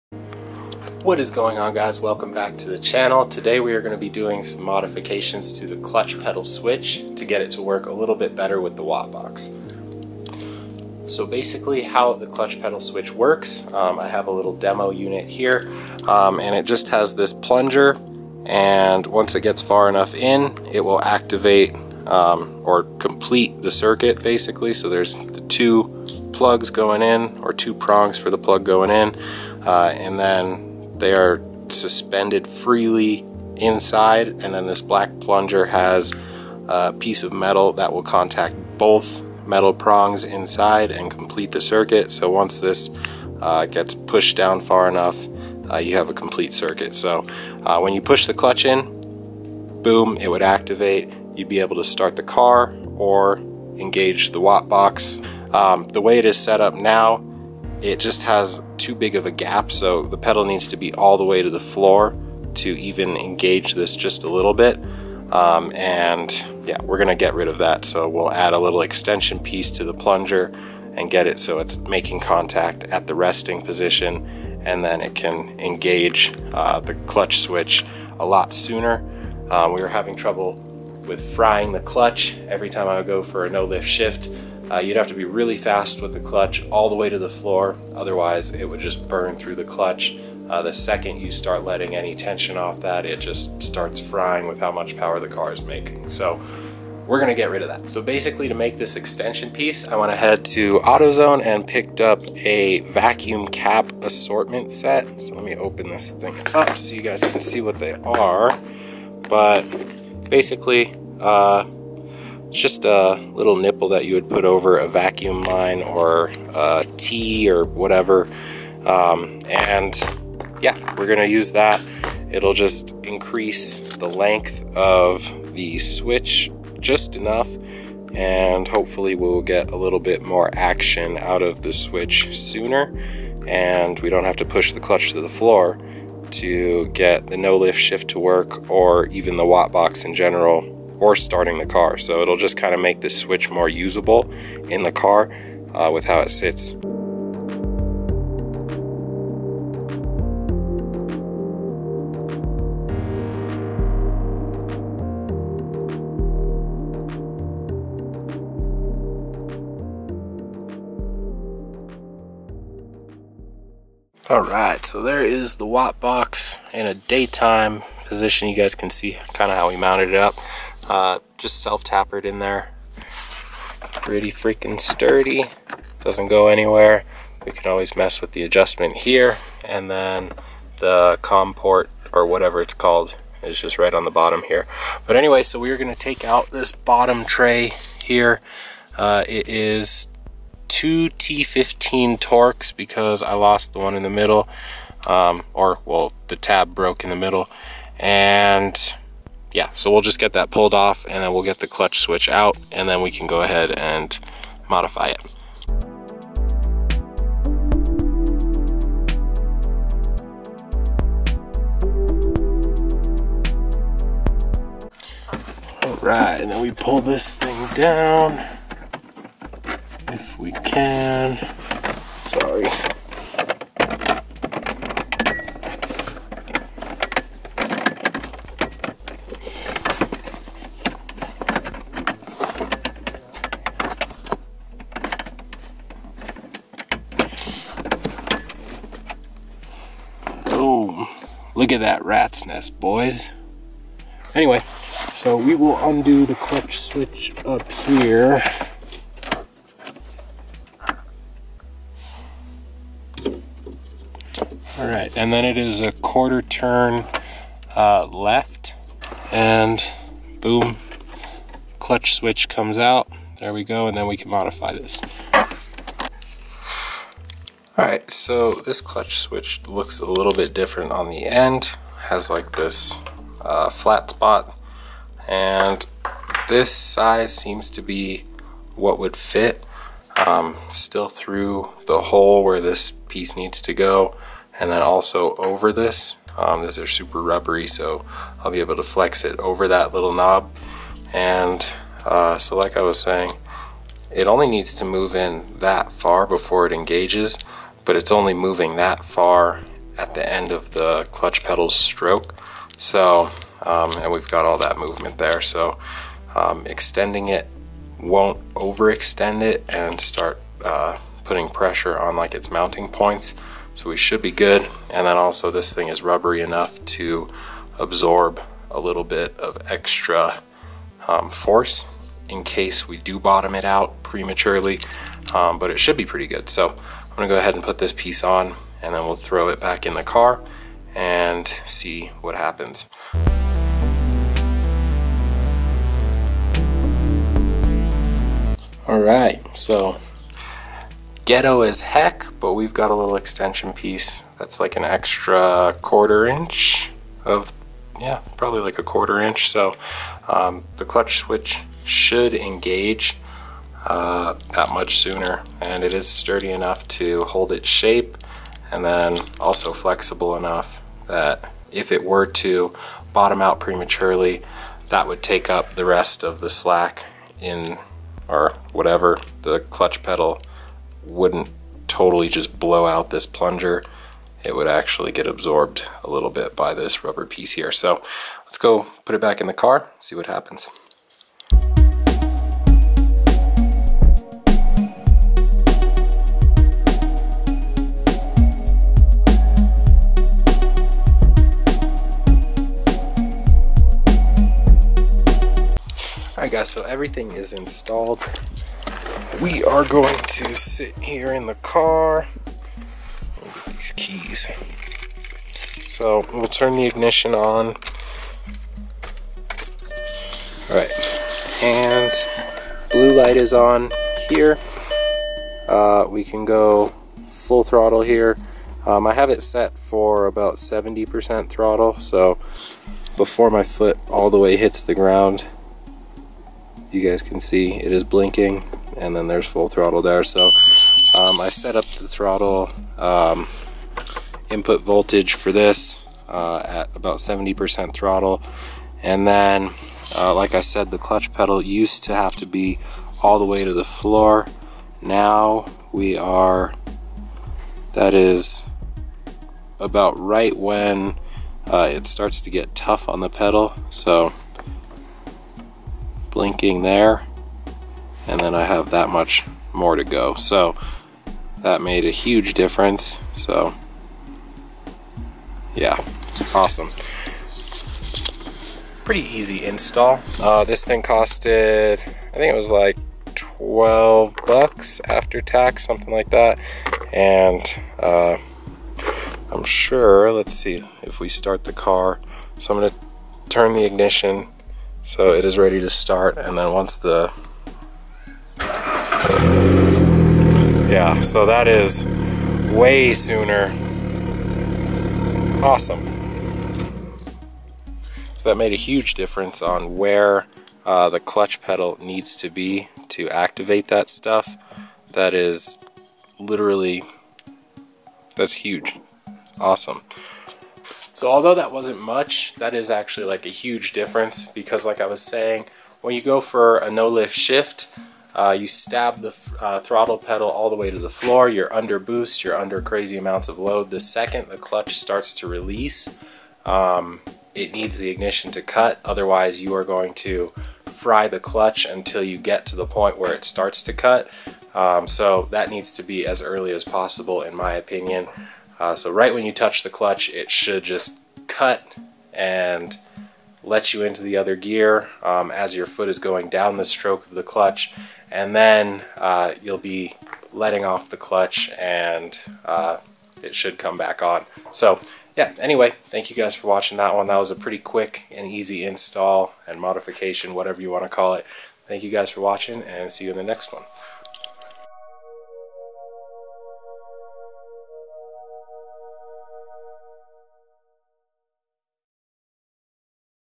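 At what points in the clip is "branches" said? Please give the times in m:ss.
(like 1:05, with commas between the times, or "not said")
not said.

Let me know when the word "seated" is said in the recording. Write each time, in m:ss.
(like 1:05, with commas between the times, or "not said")
not said.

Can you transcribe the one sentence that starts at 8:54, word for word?
Um, so that needs to be as early as possible in my opinion.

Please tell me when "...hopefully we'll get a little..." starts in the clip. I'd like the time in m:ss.
2:08.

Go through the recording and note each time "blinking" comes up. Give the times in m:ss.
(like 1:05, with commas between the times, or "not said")
7:08, 7:36.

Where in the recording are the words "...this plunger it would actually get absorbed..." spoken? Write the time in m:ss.
6:13.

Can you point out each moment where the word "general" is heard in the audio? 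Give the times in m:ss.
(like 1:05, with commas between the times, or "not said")
2:20.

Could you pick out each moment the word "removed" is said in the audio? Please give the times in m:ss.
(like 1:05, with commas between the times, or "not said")
not said.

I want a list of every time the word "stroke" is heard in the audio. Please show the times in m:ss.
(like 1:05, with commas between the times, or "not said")
5:01, 9:06.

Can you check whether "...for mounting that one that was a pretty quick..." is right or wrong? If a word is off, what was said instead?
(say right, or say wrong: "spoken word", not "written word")
wrong: "watching", not "mounting".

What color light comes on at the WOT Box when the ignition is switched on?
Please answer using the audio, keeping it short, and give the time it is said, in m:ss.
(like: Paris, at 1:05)
Blue, at 6:52.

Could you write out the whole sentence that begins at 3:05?
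But anyway, so we are going to take out this bottom tray here.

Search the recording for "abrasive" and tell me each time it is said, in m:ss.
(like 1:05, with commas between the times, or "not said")
not said.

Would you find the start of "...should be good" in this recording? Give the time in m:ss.
5:13.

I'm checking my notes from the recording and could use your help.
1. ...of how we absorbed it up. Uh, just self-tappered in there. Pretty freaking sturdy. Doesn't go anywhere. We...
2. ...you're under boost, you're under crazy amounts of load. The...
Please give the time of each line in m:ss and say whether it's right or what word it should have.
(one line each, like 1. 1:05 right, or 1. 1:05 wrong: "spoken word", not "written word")
1. 2:49 wrong: "mounted", not "absorbed"
2. 8:41 right.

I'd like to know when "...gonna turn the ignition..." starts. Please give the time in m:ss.
8:02.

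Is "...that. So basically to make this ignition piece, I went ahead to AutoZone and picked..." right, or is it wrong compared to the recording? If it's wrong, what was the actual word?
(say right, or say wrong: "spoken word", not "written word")
wrong: "extension", not "ignition".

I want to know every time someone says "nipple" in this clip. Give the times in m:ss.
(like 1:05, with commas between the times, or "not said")
1:53.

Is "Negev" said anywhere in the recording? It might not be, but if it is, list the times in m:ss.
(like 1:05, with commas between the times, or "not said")
not said.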